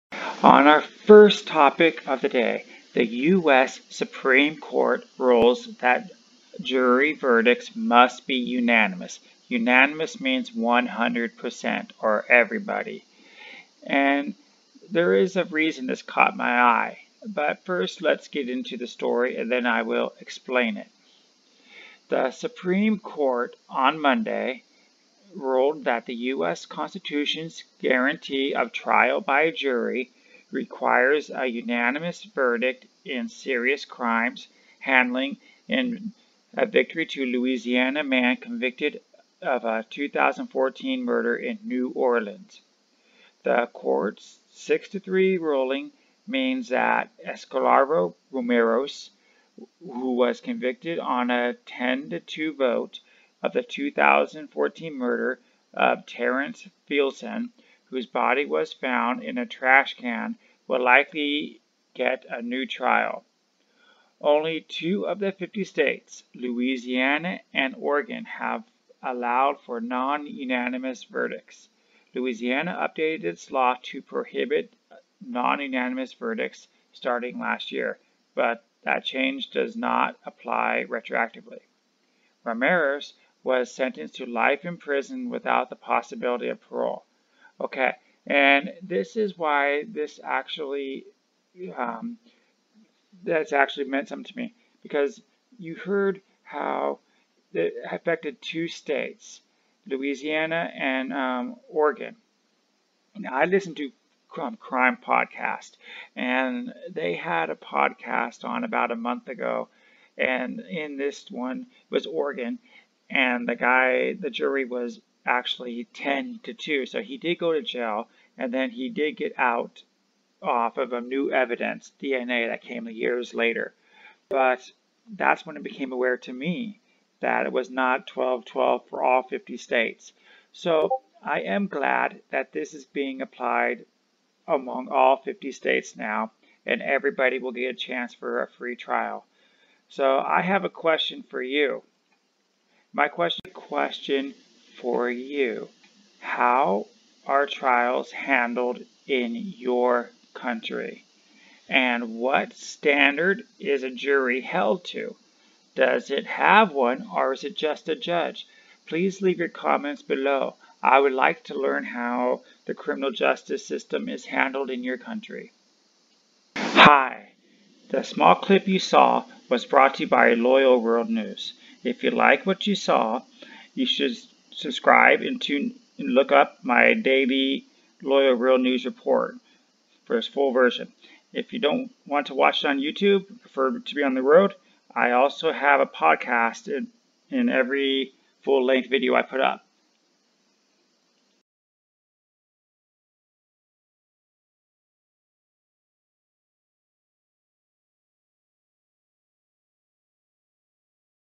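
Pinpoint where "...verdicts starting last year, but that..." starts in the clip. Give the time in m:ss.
1:16.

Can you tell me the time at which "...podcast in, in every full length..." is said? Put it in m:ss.
3:05.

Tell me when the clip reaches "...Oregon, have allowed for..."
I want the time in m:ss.
1:07.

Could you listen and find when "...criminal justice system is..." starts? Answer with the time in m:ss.
2:42.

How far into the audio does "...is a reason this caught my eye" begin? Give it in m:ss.
0:15.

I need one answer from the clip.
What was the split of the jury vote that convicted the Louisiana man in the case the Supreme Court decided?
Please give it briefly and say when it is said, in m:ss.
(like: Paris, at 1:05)
10 to 2, at 0:51.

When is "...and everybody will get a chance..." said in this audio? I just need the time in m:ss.
2:16.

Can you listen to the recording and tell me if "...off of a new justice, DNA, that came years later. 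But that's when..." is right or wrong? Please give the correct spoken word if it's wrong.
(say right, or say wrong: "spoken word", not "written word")
wrong: "evidence", not "justice".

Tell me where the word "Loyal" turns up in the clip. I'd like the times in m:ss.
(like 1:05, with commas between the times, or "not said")
2:50, 2:58.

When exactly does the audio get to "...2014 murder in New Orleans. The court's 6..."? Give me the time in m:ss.
0:39.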